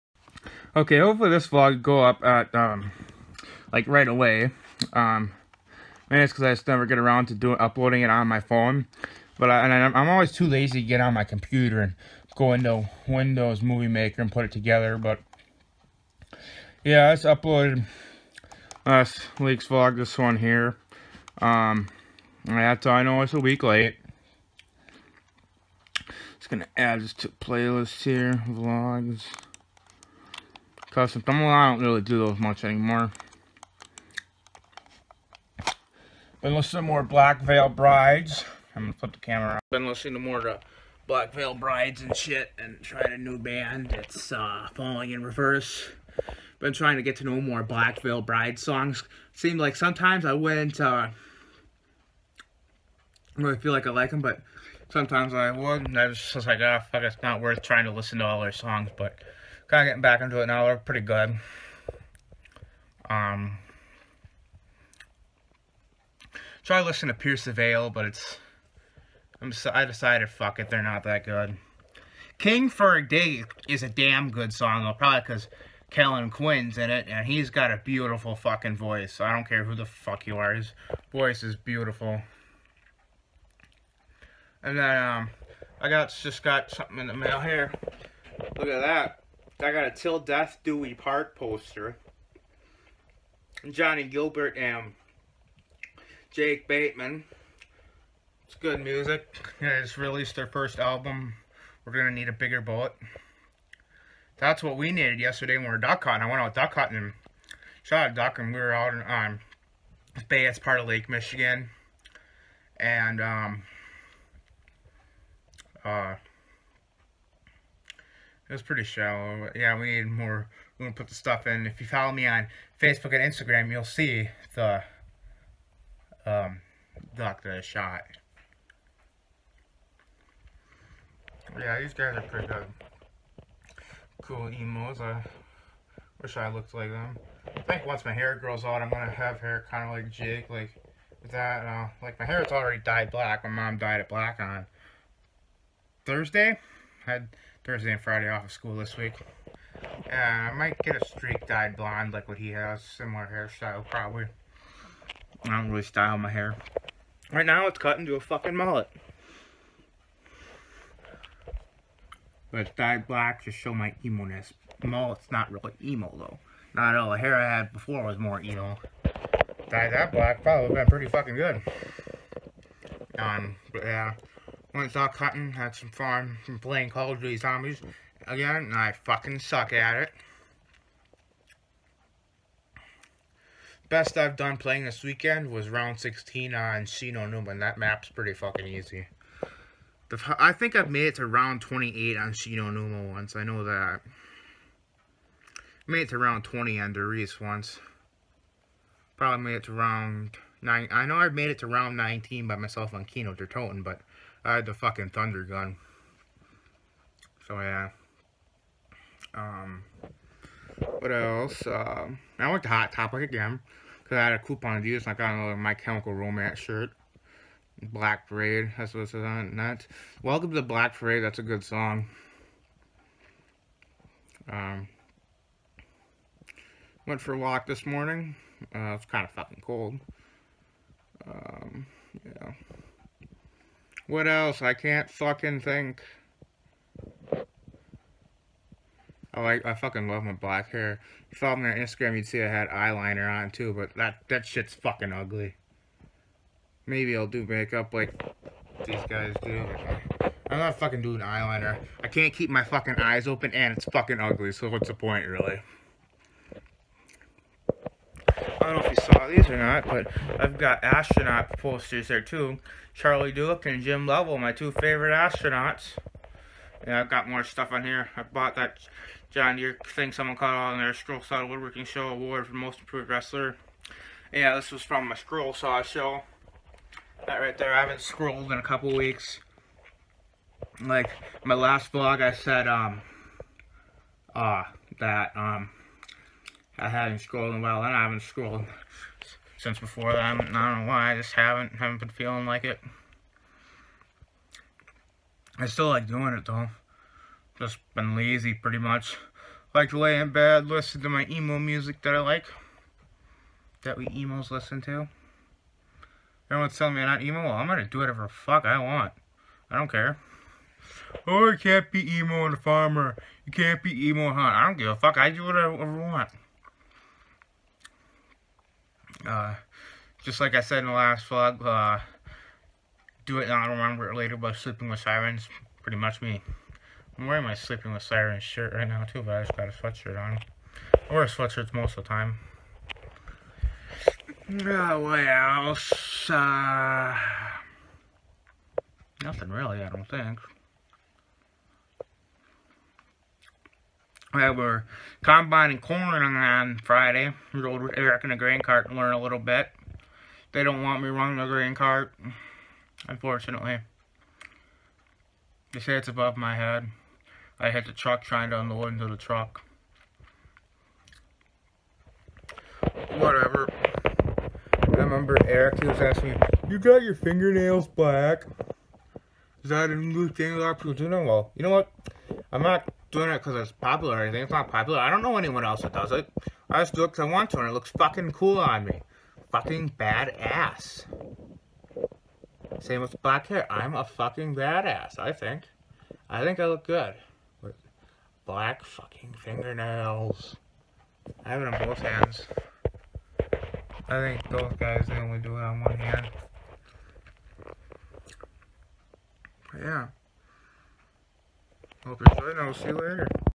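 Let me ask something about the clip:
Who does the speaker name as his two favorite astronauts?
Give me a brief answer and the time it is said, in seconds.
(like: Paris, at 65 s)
Charlie Duke and Jim Lovell, at 262 s.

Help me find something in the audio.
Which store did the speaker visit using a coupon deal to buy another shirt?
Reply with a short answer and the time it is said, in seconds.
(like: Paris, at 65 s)
Hot Topic, at 212 s.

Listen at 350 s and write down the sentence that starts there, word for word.
They don't want me running the grain cart, unfortunately.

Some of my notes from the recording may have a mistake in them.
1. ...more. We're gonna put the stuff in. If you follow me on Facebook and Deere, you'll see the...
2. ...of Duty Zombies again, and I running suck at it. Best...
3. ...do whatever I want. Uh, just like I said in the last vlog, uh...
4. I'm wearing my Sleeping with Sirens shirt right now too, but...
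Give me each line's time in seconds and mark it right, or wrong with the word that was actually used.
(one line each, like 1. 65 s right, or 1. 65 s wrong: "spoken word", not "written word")
1. 120 s wrong: "Instagram", not "Deere"
2. 177 s wrong: "fucking", not "running"
3. 315 s right
4. 327 s right.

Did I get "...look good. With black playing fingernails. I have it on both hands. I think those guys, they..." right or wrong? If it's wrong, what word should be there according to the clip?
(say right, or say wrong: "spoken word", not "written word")
wrong: "fucking", not "playing".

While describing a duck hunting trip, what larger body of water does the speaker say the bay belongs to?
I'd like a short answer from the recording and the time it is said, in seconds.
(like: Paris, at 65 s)
Lake Michigan, at 110 s.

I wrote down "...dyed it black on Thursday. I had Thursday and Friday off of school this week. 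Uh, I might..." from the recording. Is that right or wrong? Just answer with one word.
right.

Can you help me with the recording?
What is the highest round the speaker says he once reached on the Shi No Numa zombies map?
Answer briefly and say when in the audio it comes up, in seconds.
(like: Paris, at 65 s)
28, at 191 s.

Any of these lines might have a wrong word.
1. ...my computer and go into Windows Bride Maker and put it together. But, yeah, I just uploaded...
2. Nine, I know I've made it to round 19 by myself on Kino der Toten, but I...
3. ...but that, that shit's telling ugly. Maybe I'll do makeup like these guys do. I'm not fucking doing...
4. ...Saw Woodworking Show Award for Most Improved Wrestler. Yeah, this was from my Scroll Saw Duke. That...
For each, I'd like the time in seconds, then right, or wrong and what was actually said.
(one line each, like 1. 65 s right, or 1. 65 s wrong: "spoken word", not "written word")
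1. 11 s wrong: "Movie", not "Bride"
2. 200 s right
3. 243 s wrong: "fucking", not "telling"
4. 271 s wrong: "Show", not "Duke".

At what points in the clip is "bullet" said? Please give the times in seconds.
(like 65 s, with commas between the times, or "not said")
102 s.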